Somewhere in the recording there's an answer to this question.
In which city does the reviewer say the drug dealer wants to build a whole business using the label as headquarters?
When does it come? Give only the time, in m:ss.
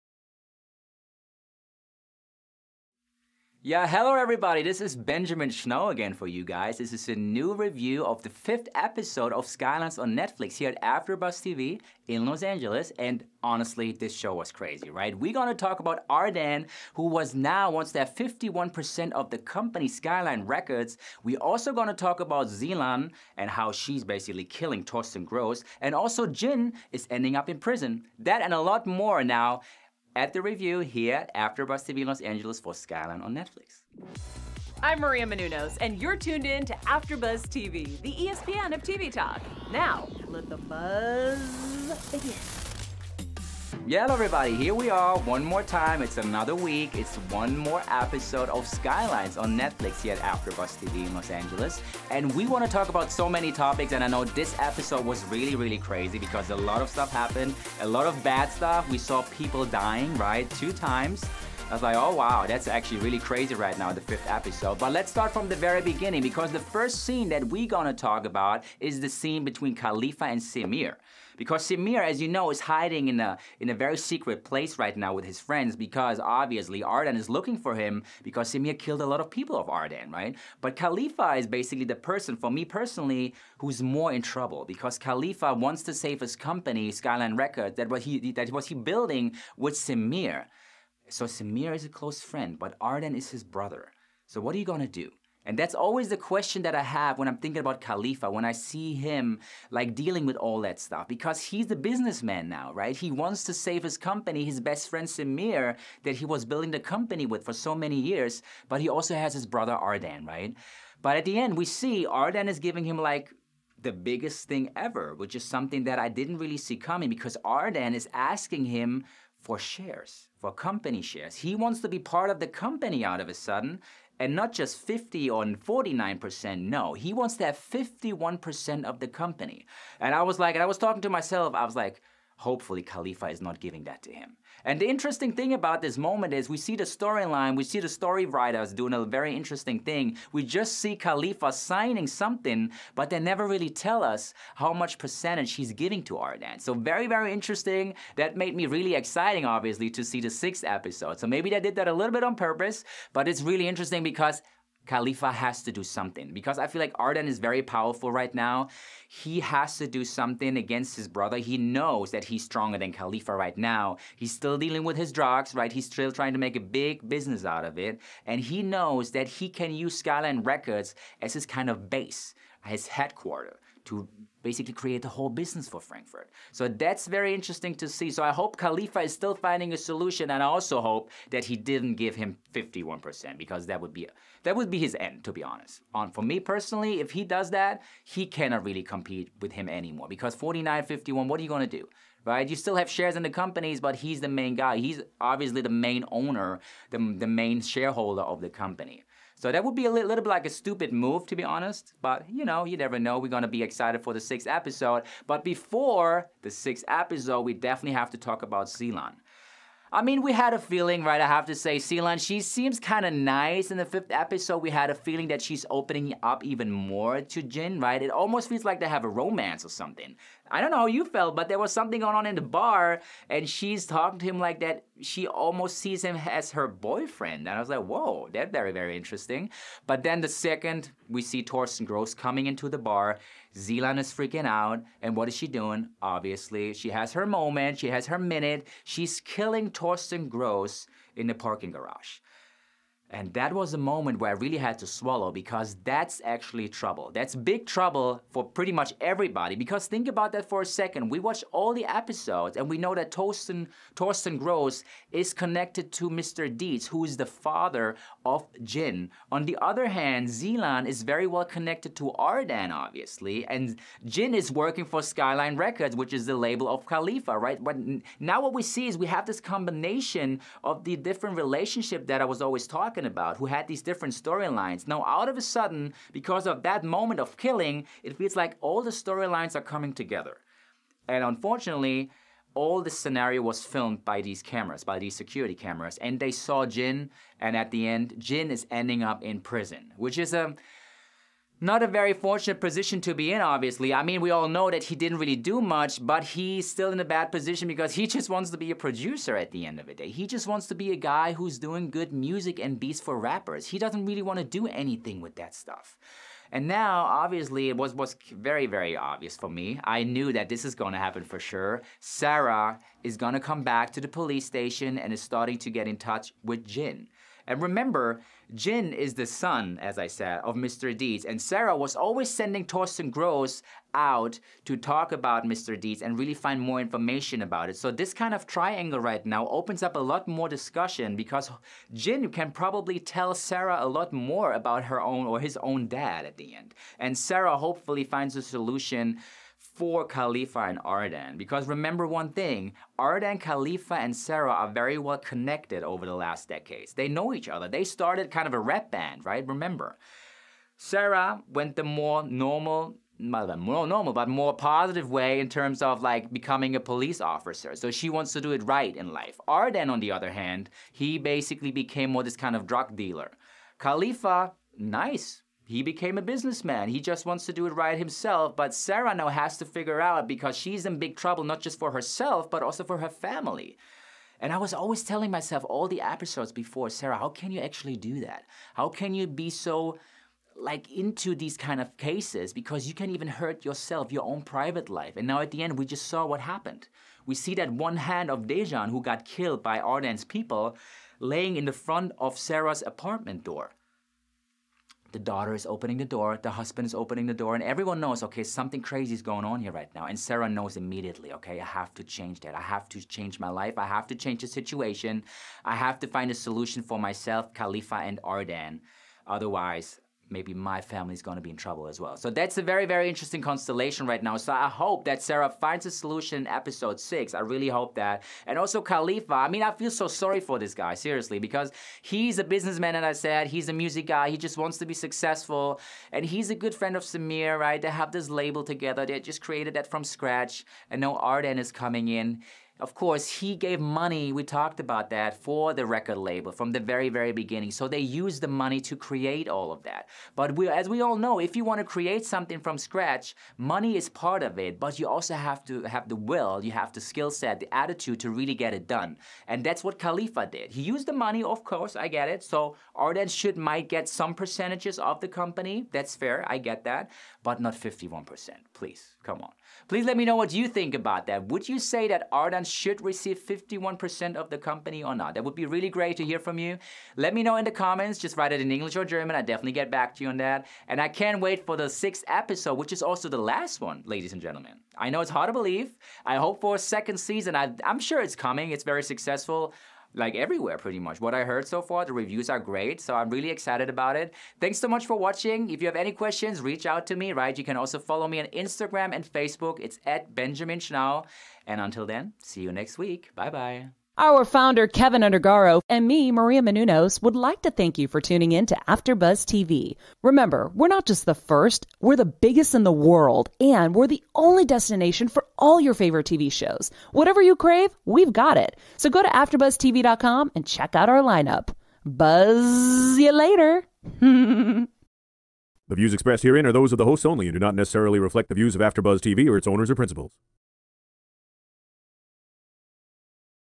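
2:55.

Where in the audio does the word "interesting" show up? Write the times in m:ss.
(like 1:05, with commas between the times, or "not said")
2:14, 2:19, 2:27, 2:33, 2:57, 3:48, 6:53.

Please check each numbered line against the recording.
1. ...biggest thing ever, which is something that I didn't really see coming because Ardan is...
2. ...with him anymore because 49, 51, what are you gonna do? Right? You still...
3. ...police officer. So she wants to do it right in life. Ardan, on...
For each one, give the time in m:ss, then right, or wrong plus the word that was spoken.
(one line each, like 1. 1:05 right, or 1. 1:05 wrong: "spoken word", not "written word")
1. 1:53 right
2. 3:09 right
3. 5:56 right.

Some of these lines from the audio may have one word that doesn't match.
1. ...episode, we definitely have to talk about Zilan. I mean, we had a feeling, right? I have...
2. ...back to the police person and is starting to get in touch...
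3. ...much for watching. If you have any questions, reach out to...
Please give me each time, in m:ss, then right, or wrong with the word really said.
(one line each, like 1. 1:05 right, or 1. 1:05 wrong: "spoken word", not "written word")
1. 3:26 right
2. 5:13 wrong: "station", not "person"
3. 8:04 right.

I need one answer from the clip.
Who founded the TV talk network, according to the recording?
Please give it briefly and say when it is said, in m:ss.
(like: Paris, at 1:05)
Keven Undergaro, at 8:14.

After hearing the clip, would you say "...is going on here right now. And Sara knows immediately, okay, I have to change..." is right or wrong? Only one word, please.
right.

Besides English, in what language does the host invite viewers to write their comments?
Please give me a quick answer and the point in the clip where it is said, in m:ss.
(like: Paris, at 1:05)
German, at 7:49.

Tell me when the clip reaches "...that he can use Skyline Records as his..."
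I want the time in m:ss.
2:49.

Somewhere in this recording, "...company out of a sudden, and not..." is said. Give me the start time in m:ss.
2:02.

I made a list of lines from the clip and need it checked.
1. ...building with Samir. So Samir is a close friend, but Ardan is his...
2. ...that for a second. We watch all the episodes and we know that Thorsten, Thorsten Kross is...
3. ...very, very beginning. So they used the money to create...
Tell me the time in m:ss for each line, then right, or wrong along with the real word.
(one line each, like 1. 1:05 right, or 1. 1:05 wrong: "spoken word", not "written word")
1. 1:28 right
2. 4:10 right
3. 7:16 right.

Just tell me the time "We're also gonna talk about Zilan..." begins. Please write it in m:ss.
0:21.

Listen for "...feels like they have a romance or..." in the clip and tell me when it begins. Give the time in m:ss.
3:38.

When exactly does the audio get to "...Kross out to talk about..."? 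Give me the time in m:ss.
5:23.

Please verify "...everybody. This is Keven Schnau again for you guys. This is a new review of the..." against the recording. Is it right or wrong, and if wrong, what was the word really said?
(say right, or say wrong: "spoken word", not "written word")
wrong: "Benjamin", not "Keven".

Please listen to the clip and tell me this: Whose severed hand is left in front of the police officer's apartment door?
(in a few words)
Dejan.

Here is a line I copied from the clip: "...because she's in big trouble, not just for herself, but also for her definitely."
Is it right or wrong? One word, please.
wrong.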